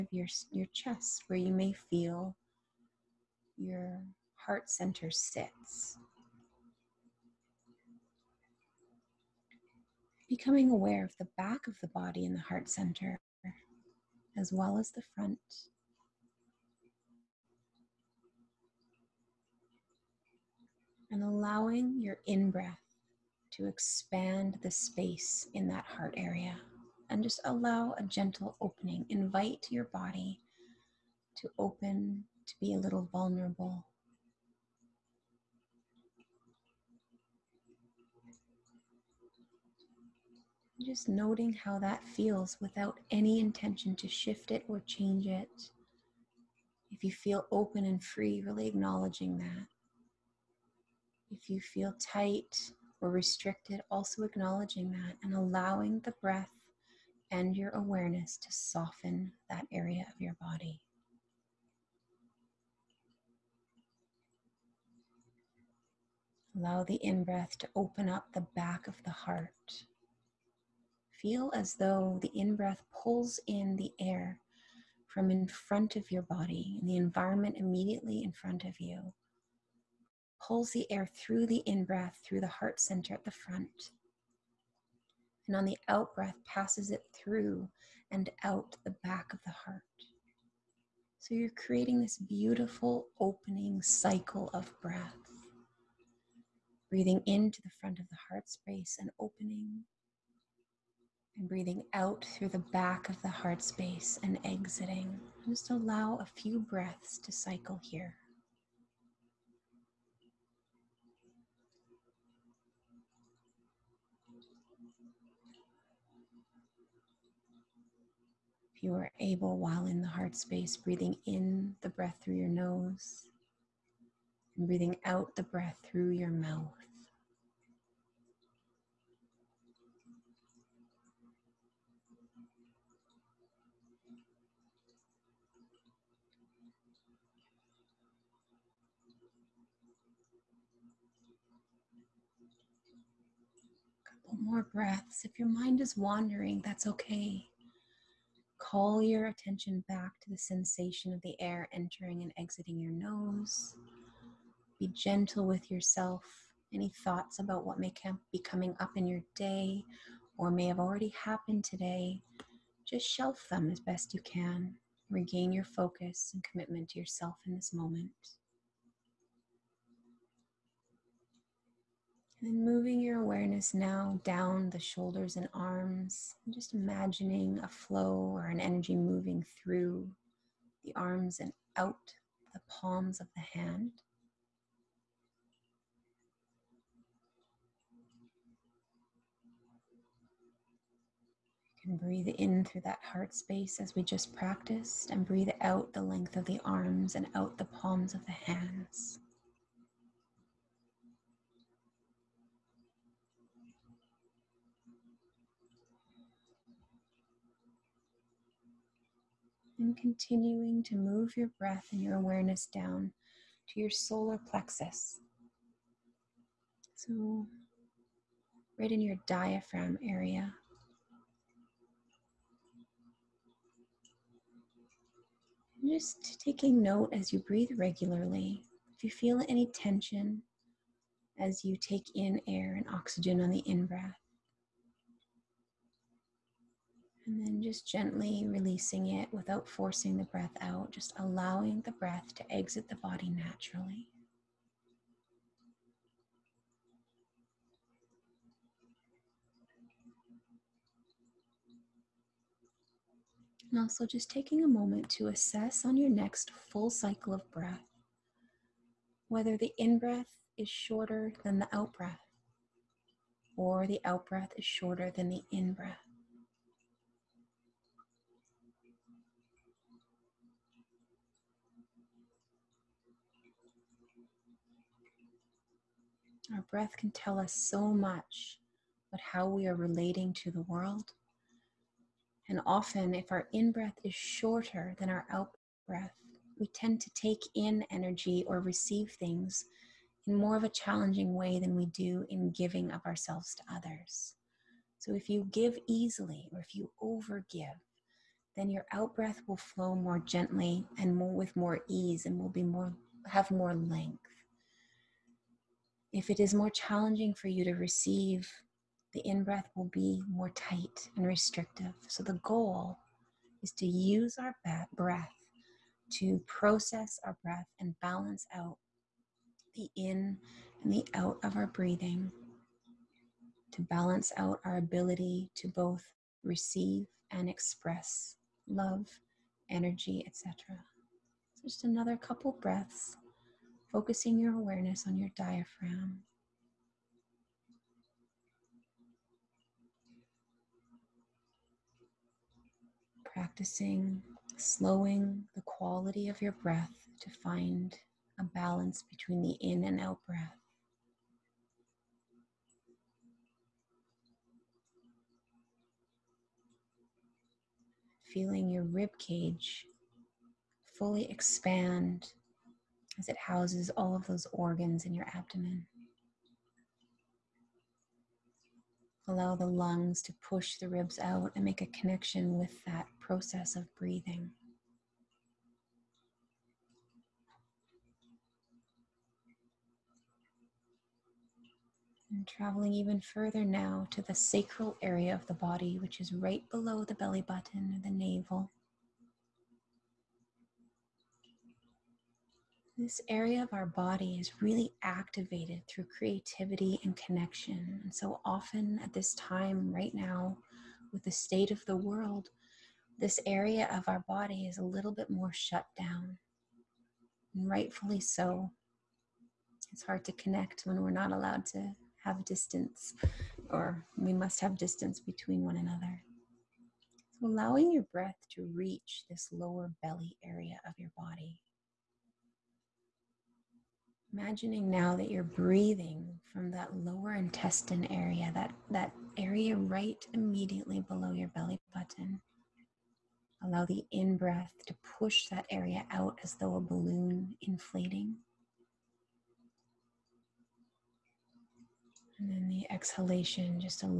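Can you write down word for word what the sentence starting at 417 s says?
So allowing your breath to reach this lower belly area of your body.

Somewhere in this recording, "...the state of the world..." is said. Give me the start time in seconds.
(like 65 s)
401 s.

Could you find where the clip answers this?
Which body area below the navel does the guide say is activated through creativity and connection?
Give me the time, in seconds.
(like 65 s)
384 s.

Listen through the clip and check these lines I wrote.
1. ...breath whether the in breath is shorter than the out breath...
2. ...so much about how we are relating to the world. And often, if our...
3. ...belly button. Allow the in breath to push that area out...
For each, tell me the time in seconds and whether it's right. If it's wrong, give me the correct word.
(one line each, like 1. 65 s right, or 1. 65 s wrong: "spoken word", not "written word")
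1. 257 s right
2. 277 s right
3. 431 s right.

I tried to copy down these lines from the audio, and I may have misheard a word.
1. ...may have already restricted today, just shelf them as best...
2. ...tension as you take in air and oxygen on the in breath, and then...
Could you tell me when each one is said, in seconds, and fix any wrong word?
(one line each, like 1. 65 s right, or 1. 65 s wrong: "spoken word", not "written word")
1. 160 s wrong: "happened", not "restricted"
2. 229 s right.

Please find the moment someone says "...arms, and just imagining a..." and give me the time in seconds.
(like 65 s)
175 s.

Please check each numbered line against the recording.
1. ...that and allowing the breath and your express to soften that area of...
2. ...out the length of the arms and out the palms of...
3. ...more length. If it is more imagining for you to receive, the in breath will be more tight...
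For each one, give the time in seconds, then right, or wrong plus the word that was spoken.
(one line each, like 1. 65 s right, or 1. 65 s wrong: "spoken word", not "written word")
1. 54 s wrong: "awareness", not "express"
2. 195 s right
3. 303 s wrong: "challenging", not "imagining".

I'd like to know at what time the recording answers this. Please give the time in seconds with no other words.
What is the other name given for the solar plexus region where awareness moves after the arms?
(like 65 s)
219 s.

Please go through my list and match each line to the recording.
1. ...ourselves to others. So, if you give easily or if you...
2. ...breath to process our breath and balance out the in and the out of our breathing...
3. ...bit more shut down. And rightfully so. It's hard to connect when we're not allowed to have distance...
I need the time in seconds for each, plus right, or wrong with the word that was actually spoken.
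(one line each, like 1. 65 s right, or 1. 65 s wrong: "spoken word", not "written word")
1. 293 s right
2. 314 s right
3. 405 s right.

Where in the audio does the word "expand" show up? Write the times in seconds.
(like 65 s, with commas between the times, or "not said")
23 s, 361 s.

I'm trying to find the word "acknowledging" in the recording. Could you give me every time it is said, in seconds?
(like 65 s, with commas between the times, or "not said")
48 s, 54 s.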